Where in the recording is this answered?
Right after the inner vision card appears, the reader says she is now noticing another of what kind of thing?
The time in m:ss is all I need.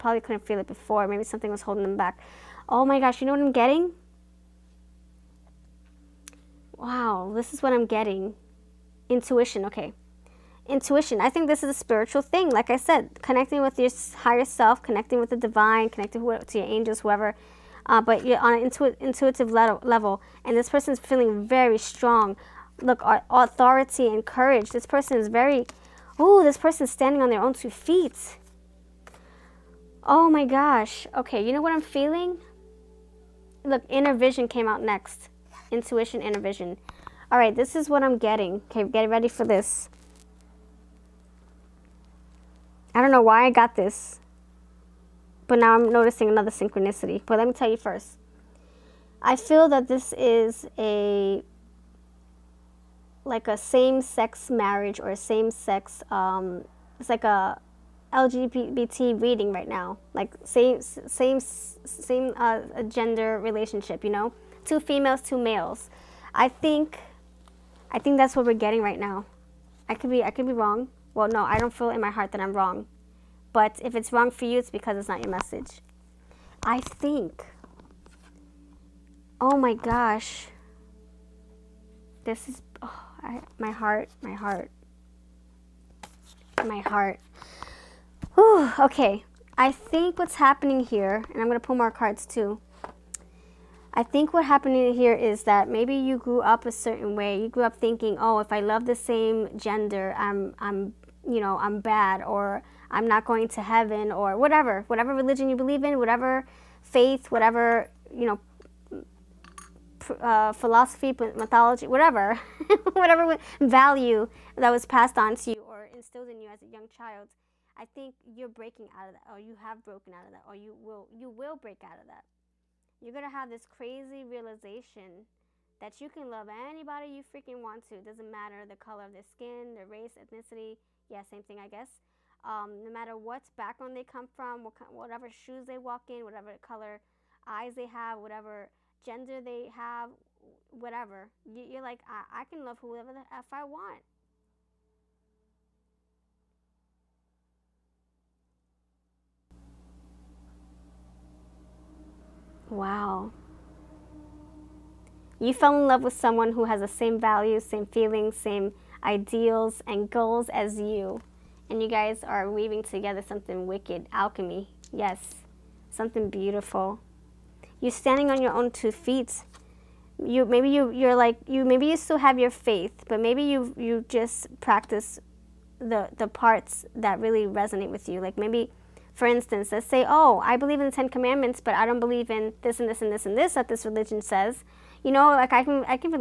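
0:46.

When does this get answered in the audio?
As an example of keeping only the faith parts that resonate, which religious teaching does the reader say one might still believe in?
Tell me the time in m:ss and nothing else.
3:00.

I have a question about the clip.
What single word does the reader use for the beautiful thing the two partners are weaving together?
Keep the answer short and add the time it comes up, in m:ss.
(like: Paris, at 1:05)
Alchemy, at 2:44.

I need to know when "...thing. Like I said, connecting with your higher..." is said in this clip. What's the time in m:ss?
0:12.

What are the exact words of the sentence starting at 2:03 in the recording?
You're gonna have this crazy realization that you can love anybody you freaking want to.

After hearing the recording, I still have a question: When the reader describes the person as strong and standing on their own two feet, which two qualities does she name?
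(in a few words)
Authority and courage.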